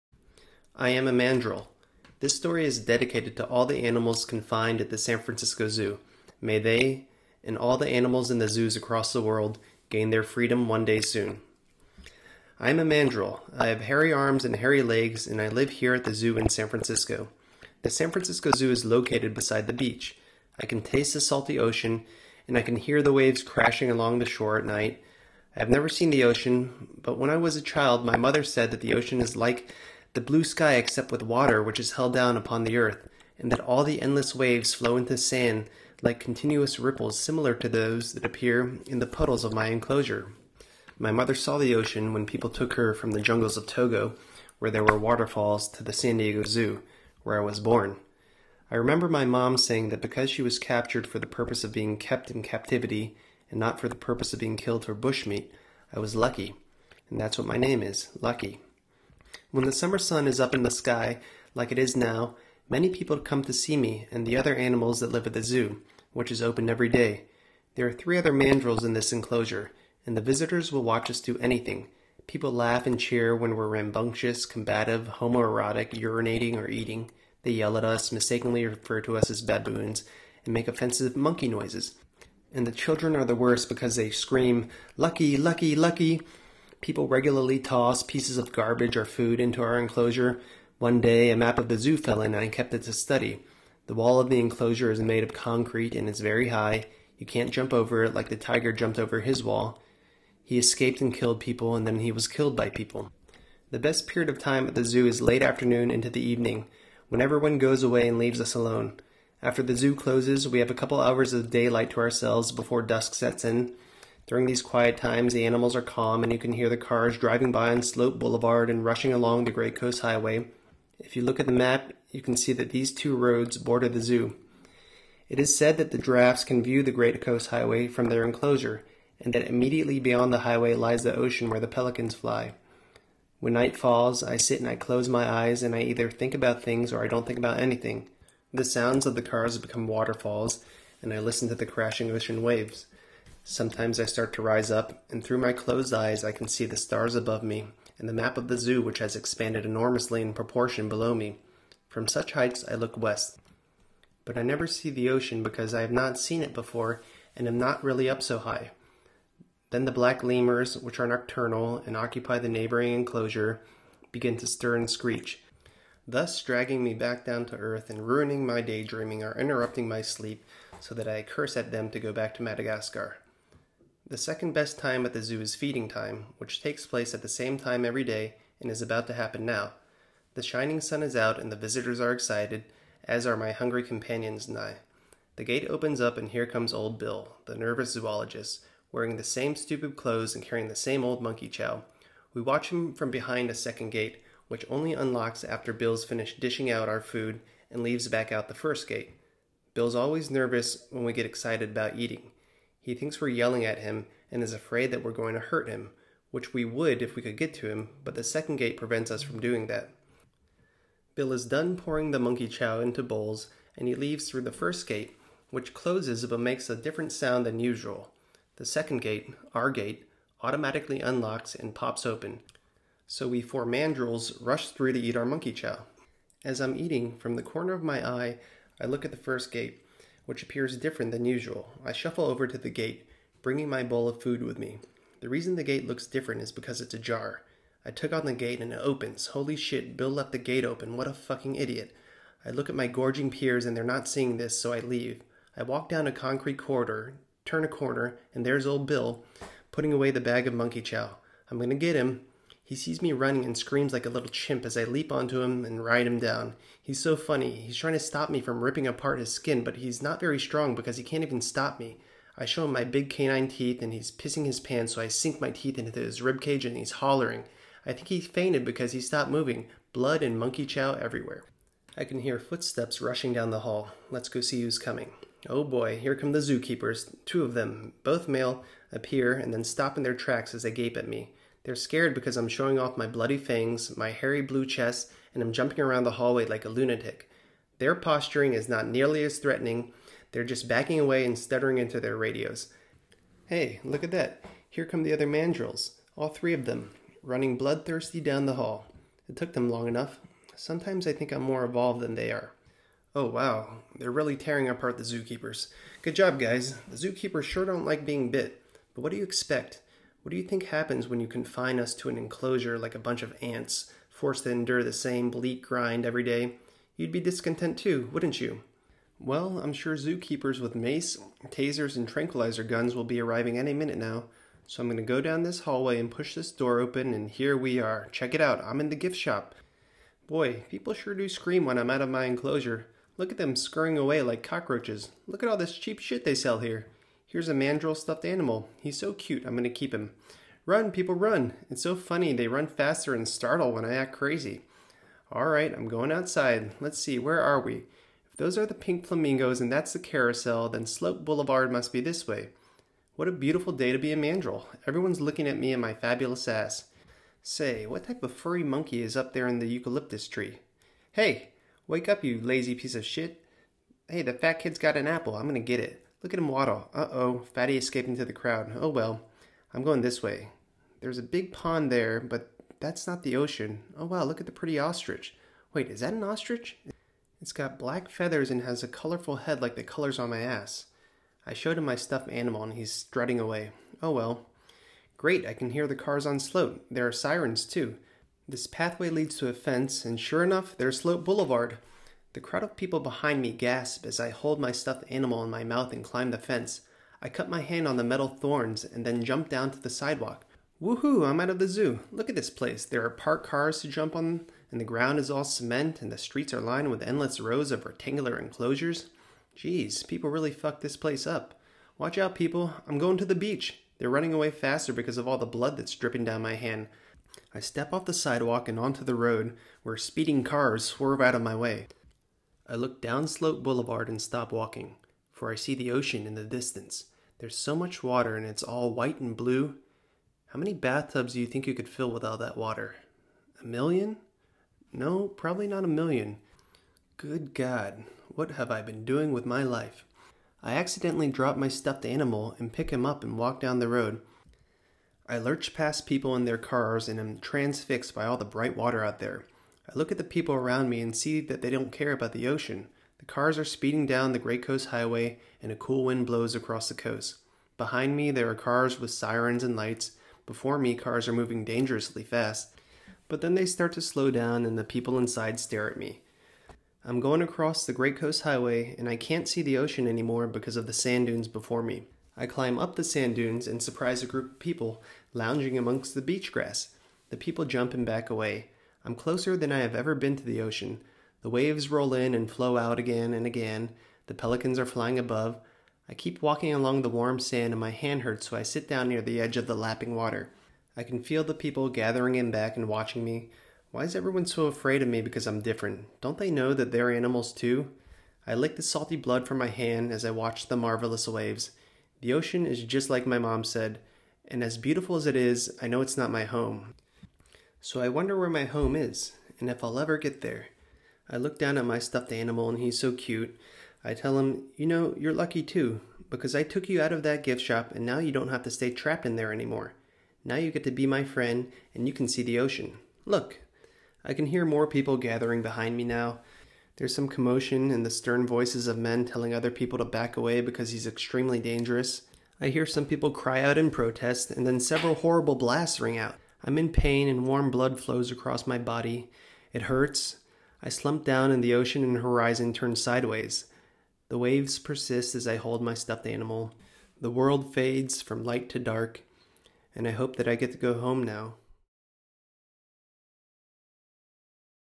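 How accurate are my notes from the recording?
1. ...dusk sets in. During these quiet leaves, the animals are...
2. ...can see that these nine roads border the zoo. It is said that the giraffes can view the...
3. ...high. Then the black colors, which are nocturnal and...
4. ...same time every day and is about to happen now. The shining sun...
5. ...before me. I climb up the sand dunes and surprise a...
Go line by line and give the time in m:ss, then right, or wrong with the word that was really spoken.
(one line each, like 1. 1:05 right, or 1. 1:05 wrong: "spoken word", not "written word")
1. 1:52 wrong: "times", not "leaves"
2. 2:02 wrong: "two", not "nine"
3. 2:38 wrong: "lemurs", not "colors"
4. 2:57 right
5. 7:51 right.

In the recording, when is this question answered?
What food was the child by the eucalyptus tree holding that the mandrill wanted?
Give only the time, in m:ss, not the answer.
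6:05.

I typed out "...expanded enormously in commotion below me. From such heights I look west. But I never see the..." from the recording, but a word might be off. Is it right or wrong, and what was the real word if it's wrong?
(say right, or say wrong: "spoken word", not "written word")
wrong: "proportion", not "commotion".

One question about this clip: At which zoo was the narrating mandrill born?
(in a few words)
San Diego Zoo.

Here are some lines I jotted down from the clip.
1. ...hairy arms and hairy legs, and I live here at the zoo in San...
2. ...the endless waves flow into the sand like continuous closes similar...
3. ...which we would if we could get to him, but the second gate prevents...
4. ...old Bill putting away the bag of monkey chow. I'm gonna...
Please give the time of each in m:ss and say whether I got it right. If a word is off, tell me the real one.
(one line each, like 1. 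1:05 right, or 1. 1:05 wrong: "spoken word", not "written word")
1. 0:13 right
2. 0:33 wrong: "ripples", not "closes"
3. 3:26 right
4. 4:08 right.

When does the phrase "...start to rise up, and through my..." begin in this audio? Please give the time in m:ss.
2:24.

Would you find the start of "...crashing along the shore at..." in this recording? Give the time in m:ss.
0:23.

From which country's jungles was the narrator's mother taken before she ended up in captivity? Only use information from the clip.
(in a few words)
Togo.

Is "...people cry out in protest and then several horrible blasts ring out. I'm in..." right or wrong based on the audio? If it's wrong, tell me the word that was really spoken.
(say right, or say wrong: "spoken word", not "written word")
right.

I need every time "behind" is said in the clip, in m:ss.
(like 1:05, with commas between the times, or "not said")
3:13, 6:33, 7:37, 8:45.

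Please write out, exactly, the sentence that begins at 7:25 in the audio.
I lurch past people in their cars and am transfixed by all the bright water out there.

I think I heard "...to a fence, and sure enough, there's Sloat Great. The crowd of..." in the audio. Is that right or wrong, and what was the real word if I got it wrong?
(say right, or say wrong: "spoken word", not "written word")
wrong: "Boulevard", not "Great".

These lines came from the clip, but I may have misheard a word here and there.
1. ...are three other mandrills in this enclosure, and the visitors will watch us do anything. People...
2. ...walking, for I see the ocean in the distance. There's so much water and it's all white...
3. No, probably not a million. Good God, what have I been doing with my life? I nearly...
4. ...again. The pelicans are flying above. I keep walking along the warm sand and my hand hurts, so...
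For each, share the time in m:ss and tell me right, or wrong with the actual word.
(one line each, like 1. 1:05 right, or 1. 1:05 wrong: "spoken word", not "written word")
1. 1:07 right
2. 7:04 right
3. 7:14 wrong: "accidentally", not "nearly"
4. 8:03 right.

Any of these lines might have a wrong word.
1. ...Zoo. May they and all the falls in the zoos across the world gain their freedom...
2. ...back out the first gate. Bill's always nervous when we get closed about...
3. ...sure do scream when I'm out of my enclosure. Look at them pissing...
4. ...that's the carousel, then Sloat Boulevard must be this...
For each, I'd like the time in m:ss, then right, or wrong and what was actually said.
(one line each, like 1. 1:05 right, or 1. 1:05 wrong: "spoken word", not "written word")
1. 0:05 wrong: "animals", not "falls"
2. 3:18 wrong: "excited", not "closed"
3. 5:30 wrong: "scurrying", not "pissing"
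4. 5:49 right.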